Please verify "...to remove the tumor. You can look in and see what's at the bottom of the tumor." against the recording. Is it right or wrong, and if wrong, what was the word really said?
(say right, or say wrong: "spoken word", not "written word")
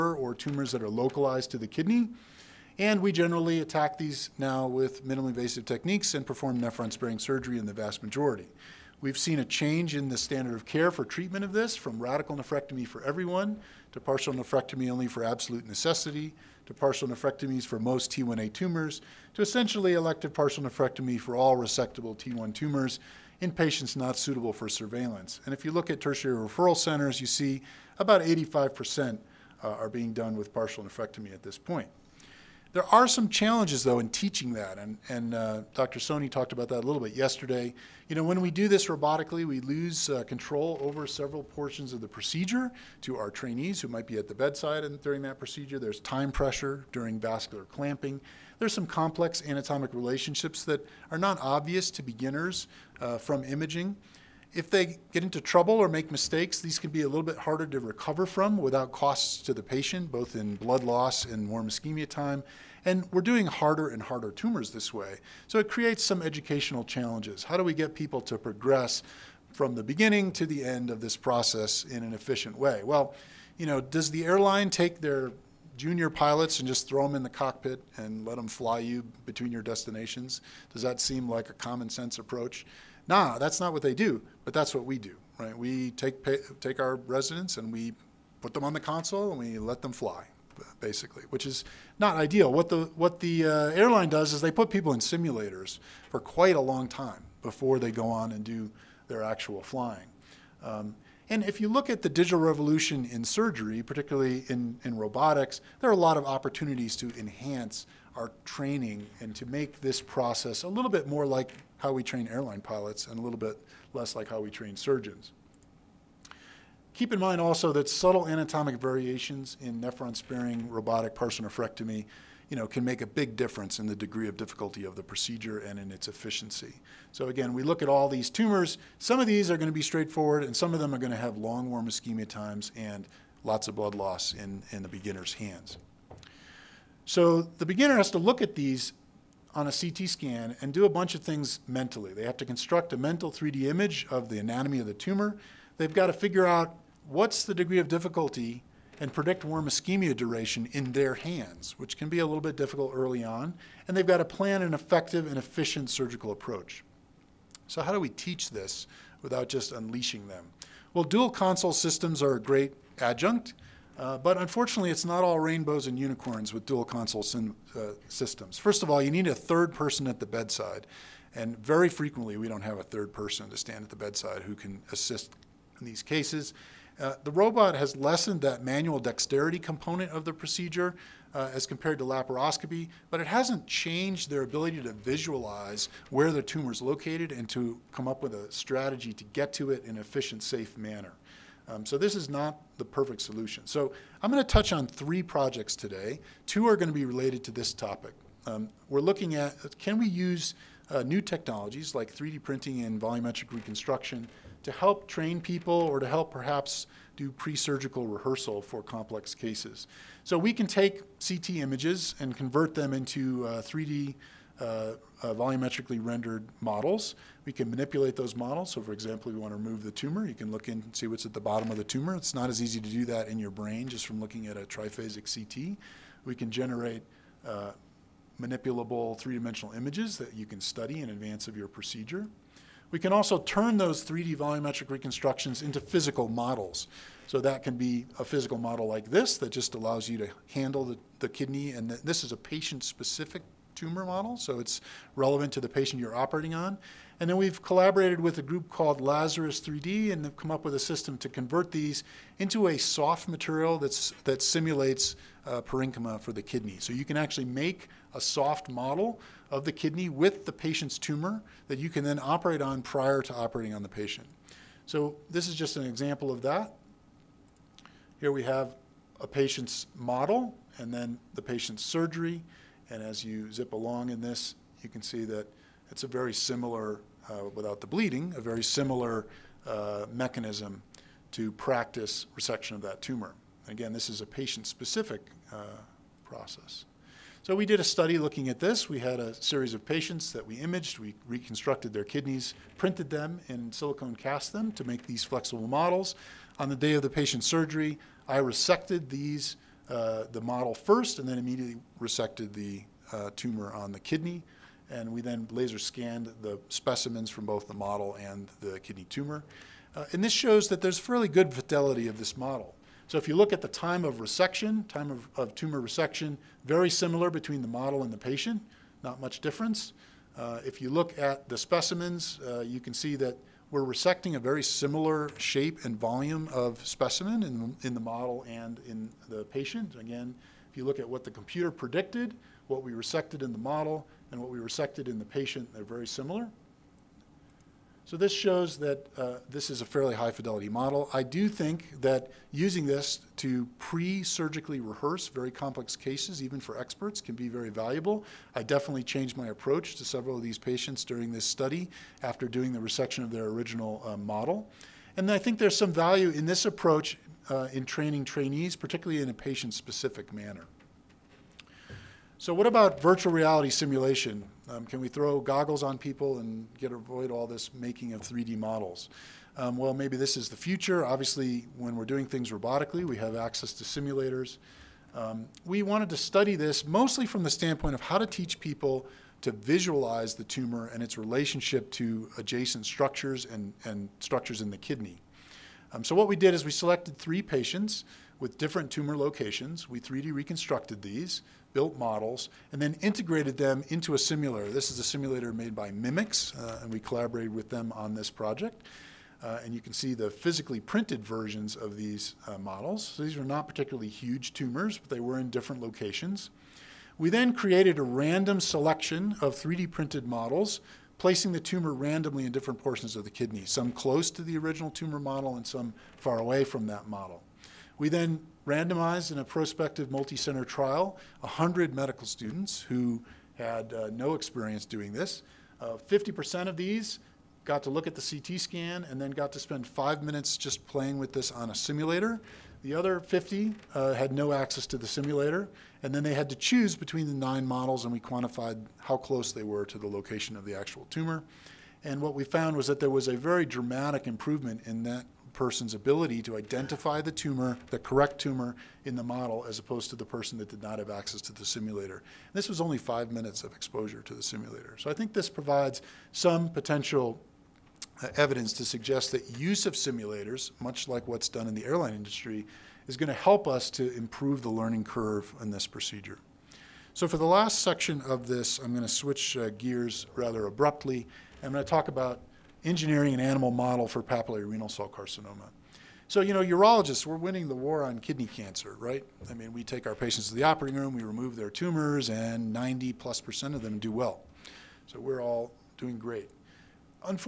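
right.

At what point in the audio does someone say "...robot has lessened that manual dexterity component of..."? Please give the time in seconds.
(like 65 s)
177 s.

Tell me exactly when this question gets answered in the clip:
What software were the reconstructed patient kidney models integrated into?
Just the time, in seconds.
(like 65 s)
395 s.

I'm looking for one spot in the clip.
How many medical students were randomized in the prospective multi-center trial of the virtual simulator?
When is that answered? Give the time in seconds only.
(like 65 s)
421 s.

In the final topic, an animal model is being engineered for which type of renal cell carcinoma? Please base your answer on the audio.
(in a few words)
Papillary.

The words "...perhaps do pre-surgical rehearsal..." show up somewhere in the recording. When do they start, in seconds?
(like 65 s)
206 s.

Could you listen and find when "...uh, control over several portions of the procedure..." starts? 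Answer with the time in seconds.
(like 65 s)
40 s.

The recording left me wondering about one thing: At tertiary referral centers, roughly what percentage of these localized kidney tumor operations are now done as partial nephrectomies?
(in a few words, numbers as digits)
85%.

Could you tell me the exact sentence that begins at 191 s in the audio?
Um, so this is not the perfect solution.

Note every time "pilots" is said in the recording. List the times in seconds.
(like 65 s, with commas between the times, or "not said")
76 s, 112 s.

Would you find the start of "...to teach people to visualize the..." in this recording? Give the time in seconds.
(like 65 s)
378 s.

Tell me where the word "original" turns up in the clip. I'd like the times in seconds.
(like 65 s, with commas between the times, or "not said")
353 s, 414 s.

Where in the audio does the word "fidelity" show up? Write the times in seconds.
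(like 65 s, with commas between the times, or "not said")
311 s, 340 s.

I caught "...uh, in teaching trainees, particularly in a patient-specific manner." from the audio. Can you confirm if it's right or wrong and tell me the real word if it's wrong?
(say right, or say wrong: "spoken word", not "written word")
wrong: "training", not "teaching".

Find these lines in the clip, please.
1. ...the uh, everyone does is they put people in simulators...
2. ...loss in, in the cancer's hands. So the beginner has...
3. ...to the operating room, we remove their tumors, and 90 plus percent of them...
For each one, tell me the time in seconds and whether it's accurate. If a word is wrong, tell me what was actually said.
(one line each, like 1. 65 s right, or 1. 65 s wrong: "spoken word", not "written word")
1. 93 s wrong: "airline", not "everyone"
2. 133 s wrong: "beginner", not "cancer"
3. 480 s right.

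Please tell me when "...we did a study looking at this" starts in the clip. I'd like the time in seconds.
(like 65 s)
287 s.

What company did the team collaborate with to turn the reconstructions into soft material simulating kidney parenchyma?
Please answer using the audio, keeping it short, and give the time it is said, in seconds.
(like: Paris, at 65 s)
Lazarus 3D, at 249 s.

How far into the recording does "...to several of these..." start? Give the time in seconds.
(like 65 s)
349 s.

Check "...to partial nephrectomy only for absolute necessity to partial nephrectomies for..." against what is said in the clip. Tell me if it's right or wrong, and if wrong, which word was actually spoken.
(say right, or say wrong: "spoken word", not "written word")
right.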